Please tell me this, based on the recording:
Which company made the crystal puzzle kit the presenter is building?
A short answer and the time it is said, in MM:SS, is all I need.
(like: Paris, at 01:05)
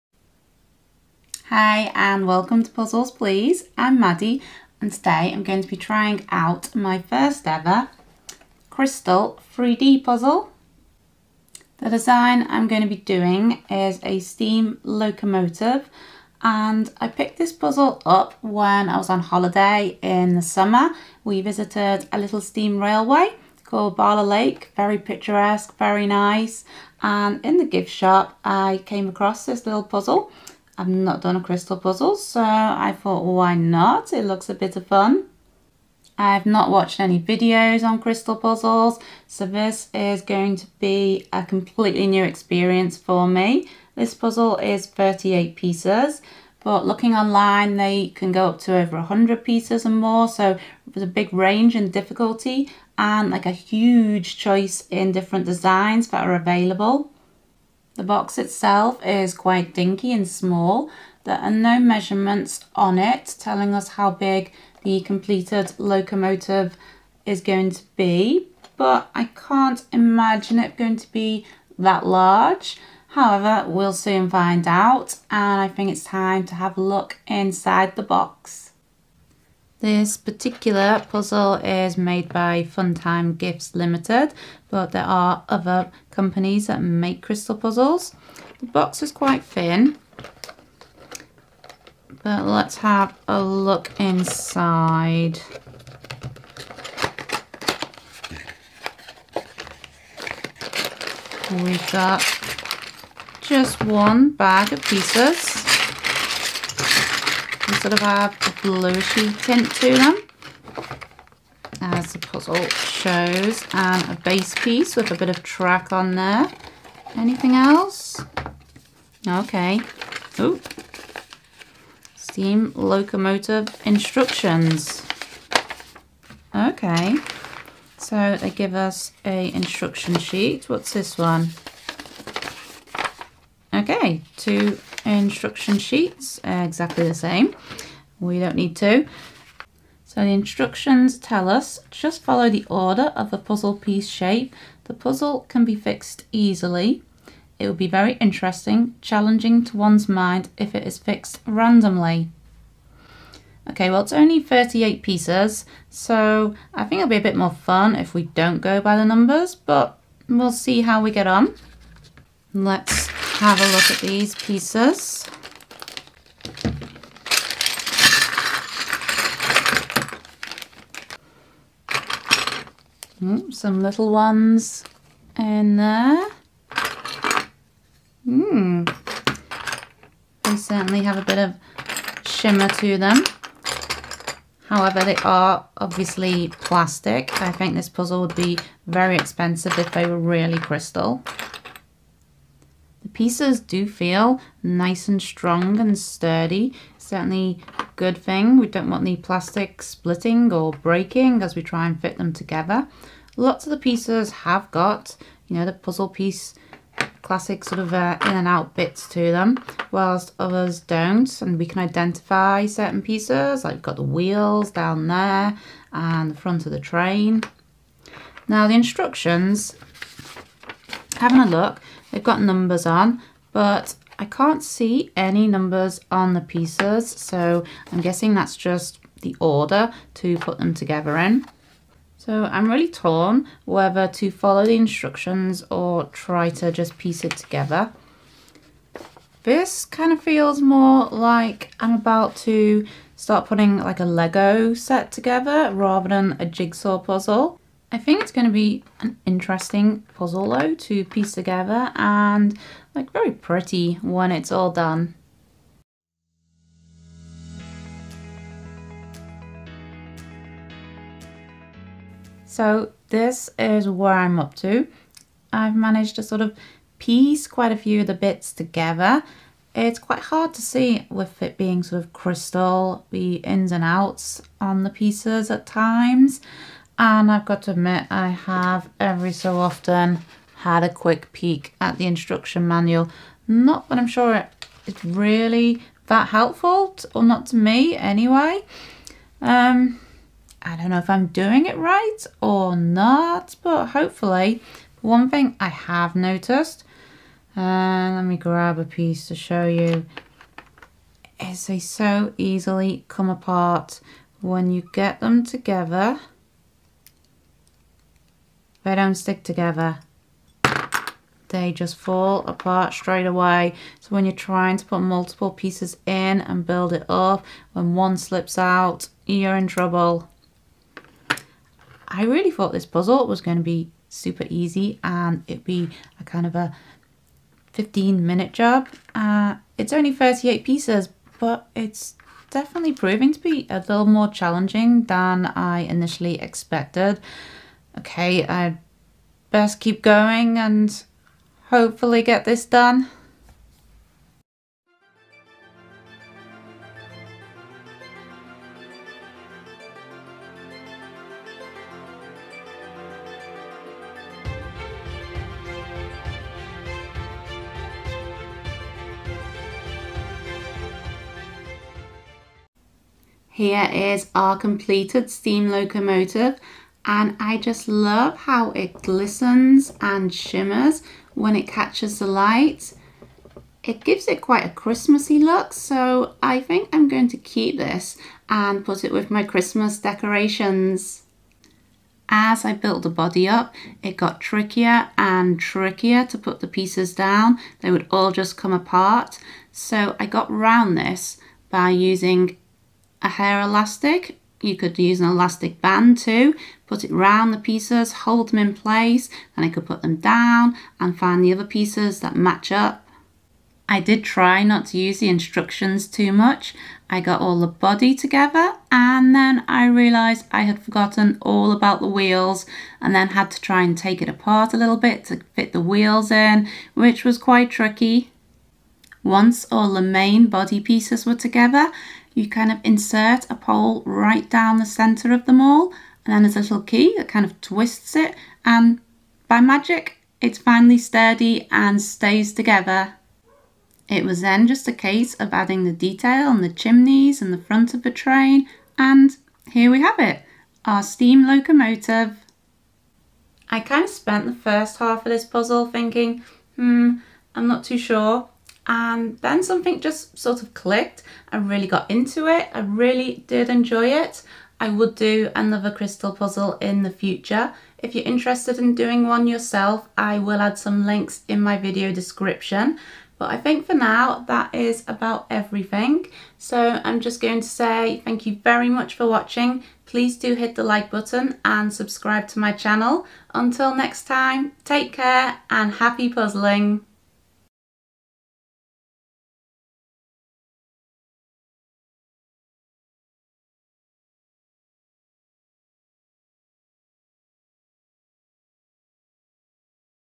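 Funtime Gifts Limited, at 01:22.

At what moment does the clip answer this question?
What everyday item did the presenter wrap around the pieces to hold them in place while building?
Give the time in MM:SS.
06:33.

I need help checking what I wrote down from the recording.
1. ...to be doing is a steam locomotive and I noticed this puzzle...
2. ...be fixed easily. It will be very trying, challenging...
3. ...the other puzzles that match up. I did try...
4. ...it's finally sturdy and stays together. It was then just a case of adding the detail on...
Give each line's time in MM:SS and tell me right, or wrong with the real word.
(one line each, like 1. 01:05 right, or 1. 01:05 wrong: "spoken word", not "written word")
1. 00:12 wrong: "picked", not "noticed"
2. 02:25 wrong: "interesting", not "trying"
3. 06:41 wrong: "pieces", not "puzzles"
4. 07:10 right.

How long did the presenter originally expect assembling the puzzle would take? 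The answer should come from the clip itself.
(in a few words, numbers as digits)
15 minutes.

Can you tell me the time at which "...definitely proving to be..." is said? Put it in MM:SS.
05:32.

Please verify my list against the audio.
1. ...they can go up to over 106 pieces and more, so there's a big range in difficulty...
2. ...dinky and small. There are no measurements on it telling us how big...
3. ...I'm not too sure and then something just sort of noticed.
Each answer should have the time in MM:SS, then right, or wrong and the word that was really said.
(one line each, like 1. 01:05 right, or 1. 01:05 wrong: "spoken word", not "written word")
1. 00:47 wrong: "100", not "106"
2. 00:59 right
3. 07:27 wrong: "clicked", not "noticed".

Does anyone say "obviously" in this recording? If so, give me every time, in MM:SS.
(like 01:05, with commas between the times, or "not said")
03:05.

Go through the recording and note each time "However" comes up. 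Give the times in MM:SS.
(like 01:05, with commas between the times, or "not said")
01:13, 03:04.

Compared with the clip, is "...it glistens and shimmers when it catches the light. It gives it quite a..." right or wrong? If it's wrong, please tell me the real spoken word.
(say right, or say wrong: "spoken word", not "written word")
right.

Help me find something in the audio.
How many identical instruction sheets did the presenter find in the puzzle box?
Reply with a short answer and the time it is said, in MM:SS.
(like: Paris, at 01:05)
2, at 02:14.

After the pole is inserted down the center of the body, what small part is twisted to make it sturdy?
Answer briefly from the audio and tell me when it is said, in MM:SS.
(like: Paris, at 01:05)
key, at 07:06.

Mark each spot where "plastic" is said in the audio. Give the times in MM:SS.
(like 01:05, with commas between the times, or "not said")
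03:06, 03:19.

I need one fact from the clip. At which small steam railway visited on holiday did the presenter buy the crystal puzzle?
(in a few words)
Bala Lake.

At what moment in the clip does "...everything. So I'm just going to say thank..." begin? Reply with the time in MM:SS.
07:45.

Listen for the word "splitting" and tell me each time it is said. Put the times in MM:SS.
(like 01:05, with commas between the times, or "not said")
03:19.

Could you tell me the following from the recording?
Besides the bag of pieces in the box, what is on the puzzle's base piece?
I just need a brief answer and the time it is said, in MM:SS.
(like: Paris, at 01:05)
track, at 01:55.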